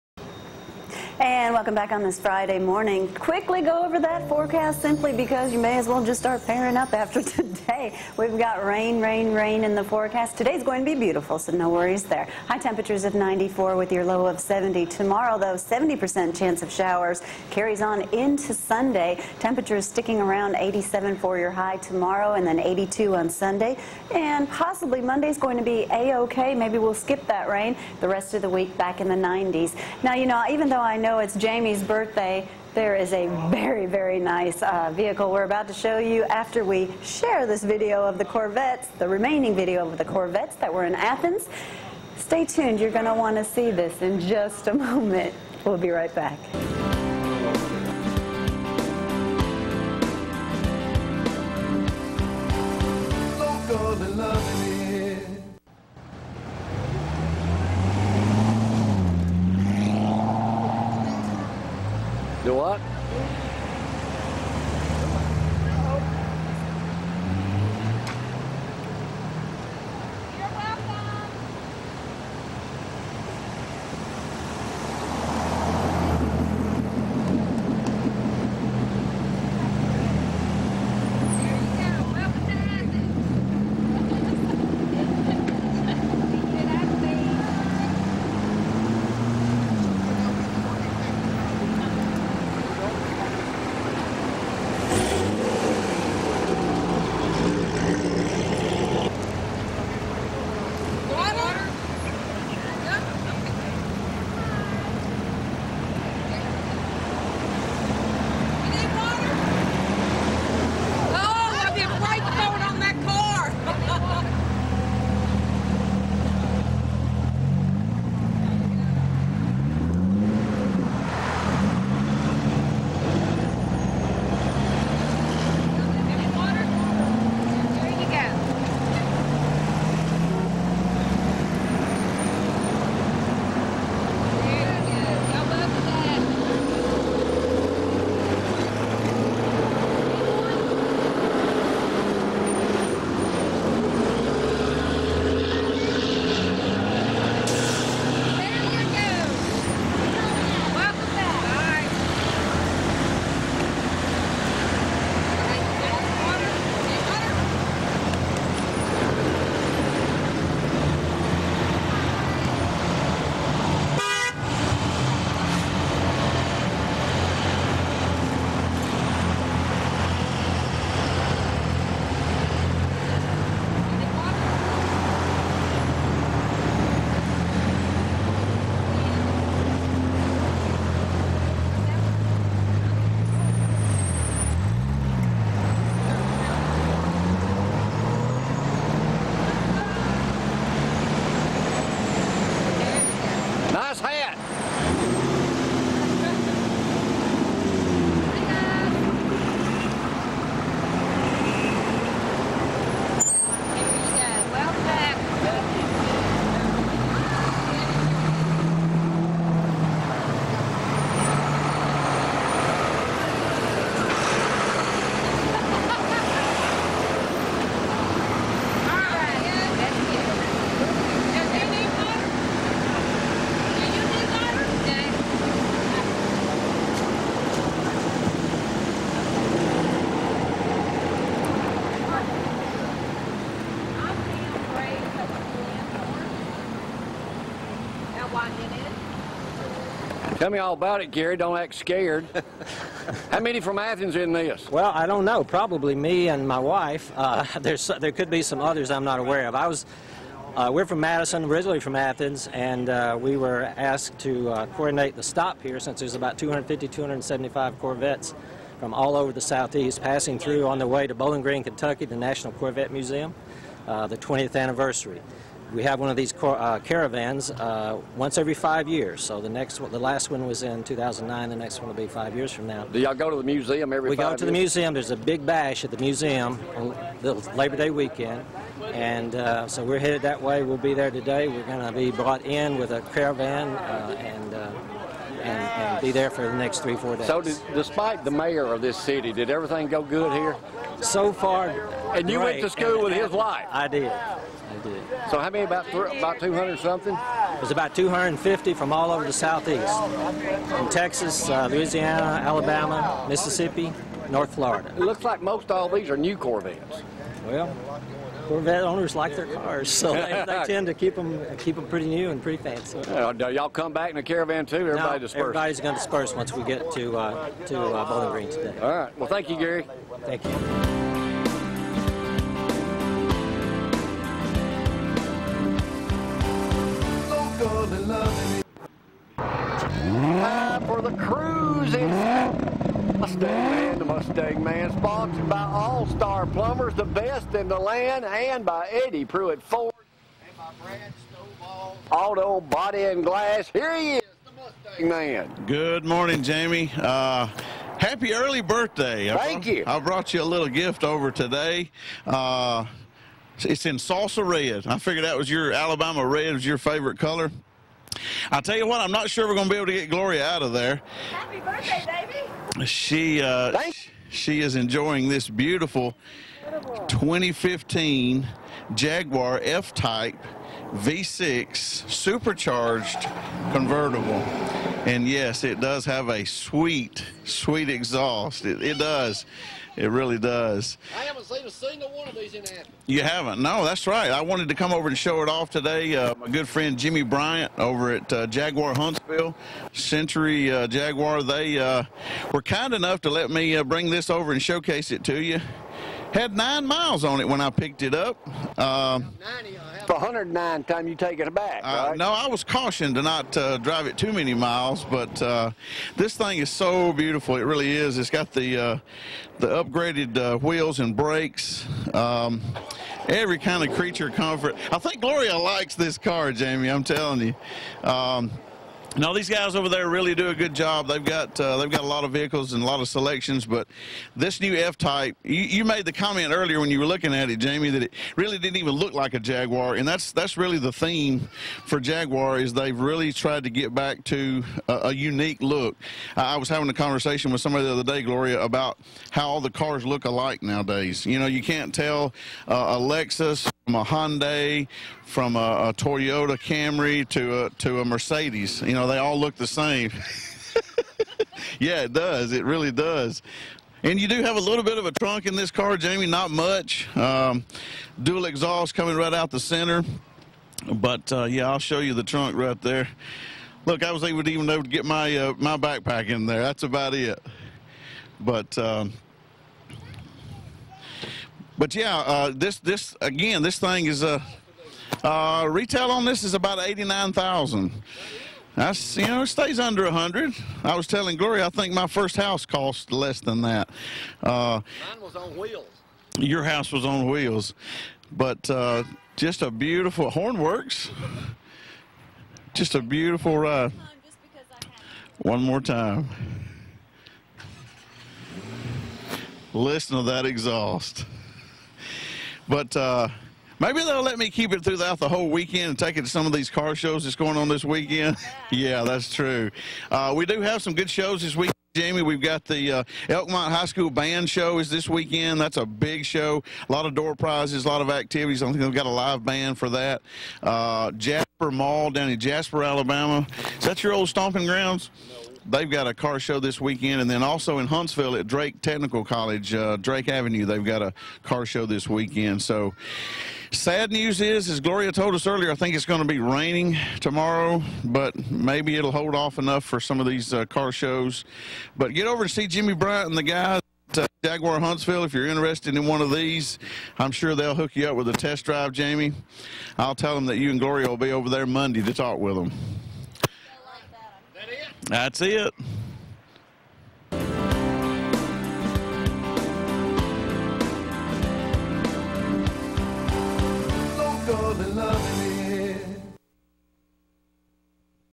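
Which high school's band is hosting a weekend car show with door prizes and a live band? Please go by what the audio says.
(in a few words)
Elkmont High School.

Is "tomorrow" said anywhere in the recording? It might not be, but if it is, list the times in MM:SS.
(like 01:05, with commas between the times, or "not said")
00:14, 00:21, 08:57.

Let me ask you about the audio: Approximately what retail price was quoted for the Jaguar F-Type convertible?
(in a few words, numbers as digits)
$89,000.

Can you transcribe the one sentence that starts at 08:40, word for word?
Uh, Jasper Mall down in Jasper, Alabama.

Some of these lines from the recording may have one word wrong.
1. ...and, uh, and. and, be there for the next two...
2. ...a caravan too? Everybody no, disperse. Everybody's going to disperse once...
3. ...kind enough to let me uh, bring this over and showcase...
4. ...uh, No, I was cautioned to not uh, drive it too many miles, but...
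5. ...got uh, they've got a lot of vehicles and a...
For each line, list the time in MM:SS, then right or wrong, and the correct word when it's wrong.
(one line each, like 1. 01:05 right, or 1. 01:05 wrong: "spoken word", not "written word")
1. 04:44 wrong: "three", not "two"
2. 05:14 right
3. 06:32 right
4. 06:41 right
5. 07:01 right.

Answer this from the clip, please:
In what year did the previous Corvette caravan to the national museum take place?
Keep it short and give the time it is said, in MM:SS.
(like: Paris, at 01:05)
2009, at 04:30.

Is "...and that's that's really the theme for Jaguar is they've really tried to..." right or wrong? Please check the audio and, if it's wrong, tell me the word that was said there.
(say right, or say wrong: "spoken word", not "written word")
right.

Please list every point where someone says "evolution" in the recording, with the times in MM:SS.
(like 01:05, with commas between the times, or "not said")
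not said.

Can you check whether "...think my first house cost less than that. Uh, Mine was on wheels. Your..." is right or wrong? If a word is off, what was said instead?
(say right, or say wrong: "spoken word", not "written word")
right.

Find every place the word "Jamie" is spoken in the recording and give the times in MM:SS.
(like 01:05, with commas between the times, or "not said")
00:31, 05:46, 06:56, 07:07, 07:35, 08:31, 09:08.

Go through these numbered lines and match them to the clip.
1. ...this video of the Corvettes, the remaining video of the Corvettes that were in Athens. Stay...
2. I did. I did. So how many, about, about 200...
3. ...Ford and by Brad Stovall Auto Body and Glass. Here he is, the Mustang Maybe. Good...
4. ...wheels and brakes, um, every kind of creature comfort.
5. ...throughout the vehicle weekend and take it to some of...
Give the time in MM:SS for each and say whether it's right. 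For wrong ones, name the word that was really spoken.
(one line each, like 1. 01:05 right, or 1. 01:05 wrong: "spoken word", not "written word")
1. 00:37 right
2. 04:53 right
3. 05:39 wrong: "Man", not "Maybe"
4. 06:50 right
5. 08:24 wrong: "whole", not "vehicle".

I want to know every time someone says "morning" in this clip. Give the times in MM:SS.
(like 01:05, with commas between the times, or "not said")
00:02, 05:46.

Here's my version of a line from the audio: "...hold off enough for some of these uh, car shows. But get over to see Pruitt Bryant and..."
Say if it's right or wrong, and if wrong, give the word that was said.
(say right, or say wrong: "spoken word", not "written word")
wrong: "Jimmy", not "Pruitt".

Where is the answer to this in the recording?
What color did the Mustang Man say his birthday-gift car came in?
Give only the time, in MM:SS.
05:53.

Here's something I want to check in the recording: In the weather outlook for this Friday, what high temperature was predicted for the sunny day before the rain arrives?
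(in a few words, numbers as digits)
94.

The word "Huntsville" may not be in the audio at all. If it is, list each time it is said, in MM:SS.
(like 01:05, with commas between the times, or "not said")
06:28, 08:47, 09:04.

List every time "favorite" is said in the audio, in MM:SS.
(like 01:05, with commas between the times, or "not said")
05:56.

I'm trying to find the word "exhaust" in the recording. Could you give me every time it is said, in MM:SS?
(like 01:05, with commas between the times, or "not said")
06:17, 07:38, 08:20.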